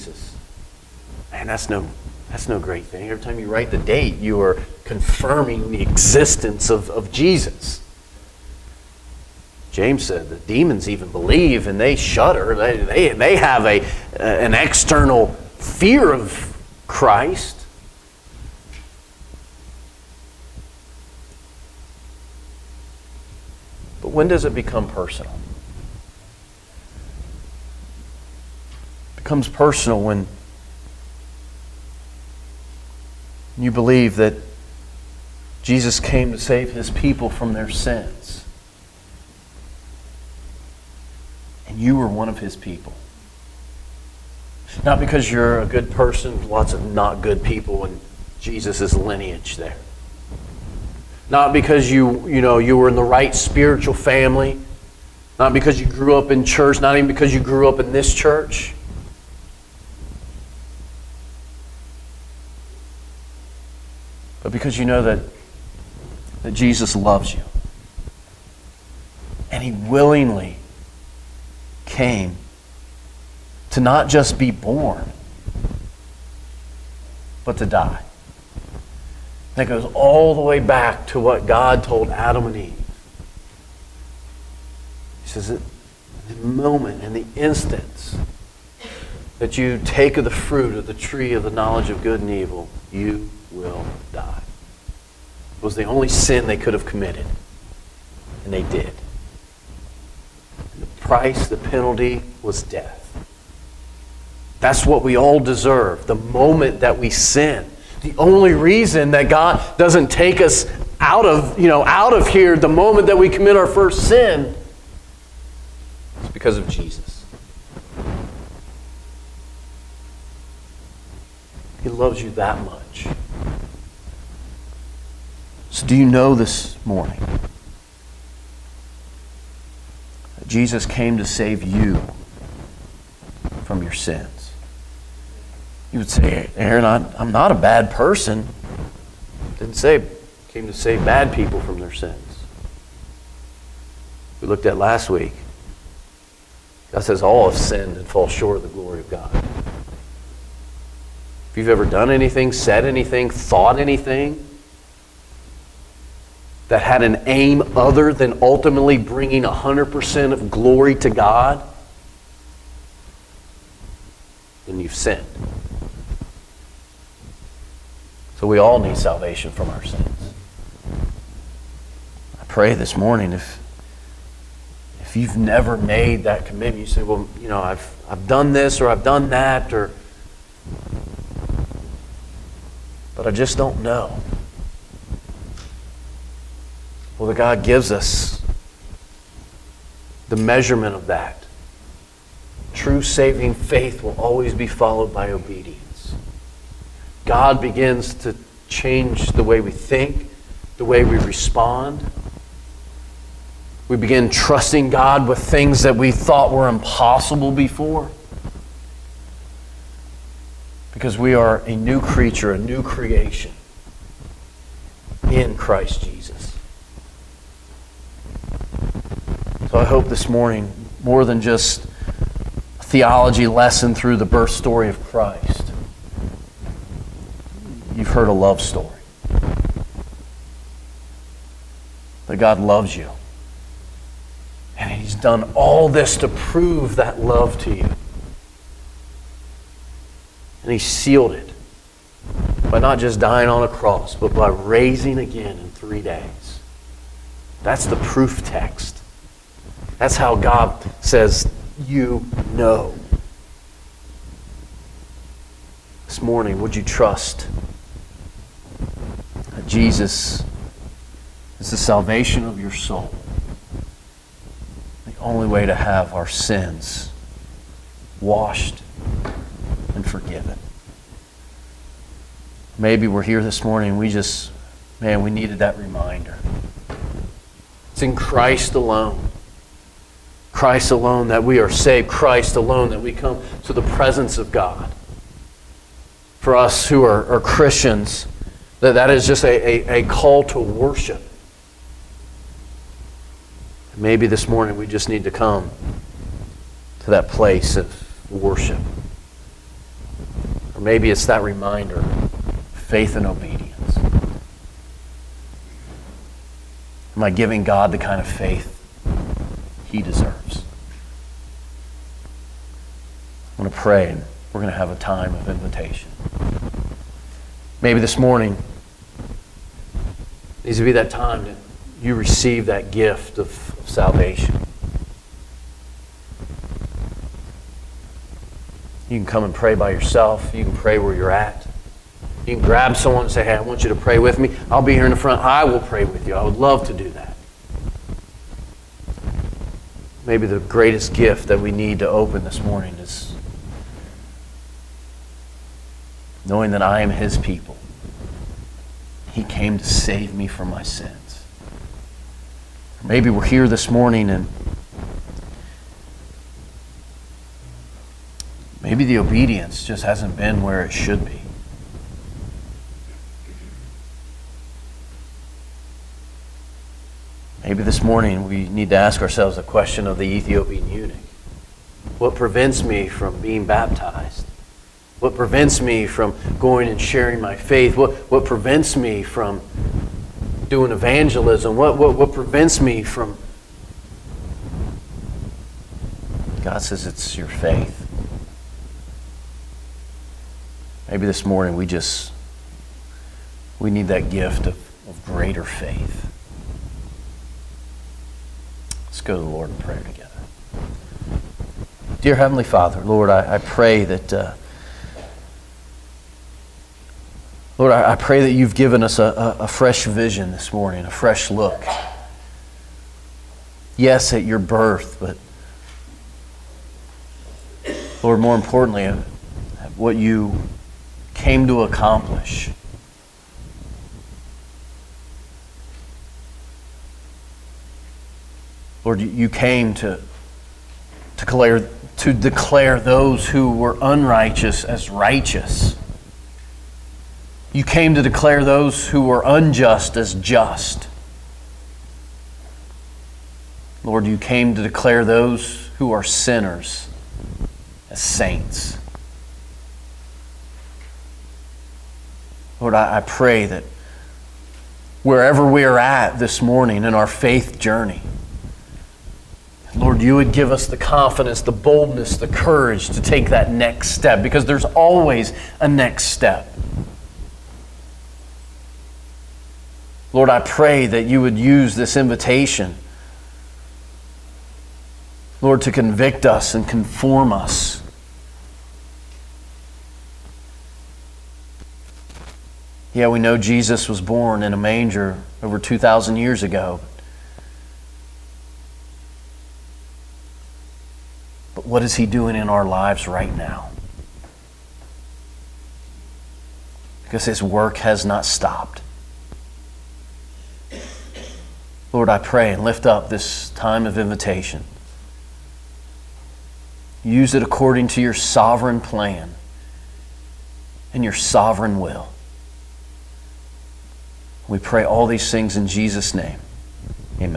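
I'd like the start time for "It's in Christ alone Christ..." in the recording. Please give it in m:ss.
4:37.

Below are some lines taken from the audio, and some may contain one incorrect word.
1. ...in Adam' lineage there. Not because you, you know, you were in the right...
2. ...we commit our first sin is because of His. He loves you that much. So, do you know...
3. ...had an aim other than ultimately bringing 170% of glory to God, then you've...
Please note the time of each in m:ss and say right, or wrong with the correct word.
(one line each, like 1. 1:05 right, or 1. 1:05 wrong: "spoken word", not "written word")
1. 0:47 wrong: "Jesus", not "Adam"
2. 1:53 wrong: "Jesus", not "His"
3. 2:36 wrong: "100", not "170".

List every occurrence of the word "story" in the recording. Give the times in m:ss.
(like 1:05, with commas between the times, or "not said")
3:44, 3:48.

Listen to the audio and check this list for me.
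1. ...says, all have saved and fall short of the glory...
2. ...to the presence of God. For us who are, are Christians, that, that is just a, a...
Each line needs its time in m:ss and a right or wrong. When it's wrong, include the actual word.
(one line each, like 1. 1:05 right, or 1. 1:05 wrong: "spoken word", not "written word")
1. 2:27 wrong: "sinned", not "saved"
2. 4:43 right.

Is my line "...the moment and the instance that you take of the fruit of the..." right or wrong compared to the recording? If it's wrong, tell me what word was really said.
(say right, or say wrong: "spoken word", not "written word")
right.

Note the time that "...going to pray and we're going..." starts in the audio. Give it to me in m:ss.
5:13.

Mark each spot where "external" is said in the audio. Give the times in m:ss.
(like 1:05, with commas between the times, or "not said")
0:14.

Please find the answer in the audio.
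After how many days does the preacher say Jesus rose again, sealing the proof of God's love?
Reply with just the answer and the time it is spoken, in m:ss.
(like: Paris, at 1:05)
3, at 4:05.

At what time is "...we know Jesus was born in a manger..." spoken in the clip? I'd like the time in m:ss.
8:03.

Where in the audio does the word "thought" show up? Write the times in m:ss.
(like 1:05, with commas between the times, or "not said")
2:33, 3:26.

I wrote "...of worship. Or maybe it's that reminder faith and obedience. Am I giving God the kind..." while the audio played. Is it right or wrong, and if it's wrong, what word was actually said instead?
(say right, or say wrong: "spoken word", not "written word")
right.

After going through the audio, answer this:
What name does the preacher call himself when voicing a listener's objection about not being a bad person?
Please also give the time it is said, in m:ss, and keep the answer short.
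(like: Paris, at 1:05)
Aarron, at 2:16.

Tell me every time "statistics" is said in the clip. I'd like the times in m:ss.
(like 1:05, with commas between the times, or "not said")
not said.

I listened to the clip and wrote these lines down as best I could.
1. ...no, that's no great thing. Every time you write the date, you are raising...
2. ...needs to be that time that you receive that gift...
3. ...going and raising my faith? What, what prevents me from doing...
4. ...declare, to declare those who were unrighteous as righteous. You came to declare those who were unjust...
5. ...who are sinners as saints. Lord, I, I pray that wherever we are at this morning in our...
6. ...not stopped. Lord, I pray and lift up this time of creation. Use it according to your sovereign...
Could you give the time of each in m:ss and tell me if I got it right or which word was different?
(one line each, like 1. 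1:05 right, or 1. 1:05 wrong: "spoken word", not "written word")
1. 0:01 wrong: "confirming", not "raising"
2. 5:20 right
3. 6:16 wrong: "sharing", not "raising"
4. 7:11 right
5. 7:25 right
6. 8:18 wrong: "invitation", not "creation".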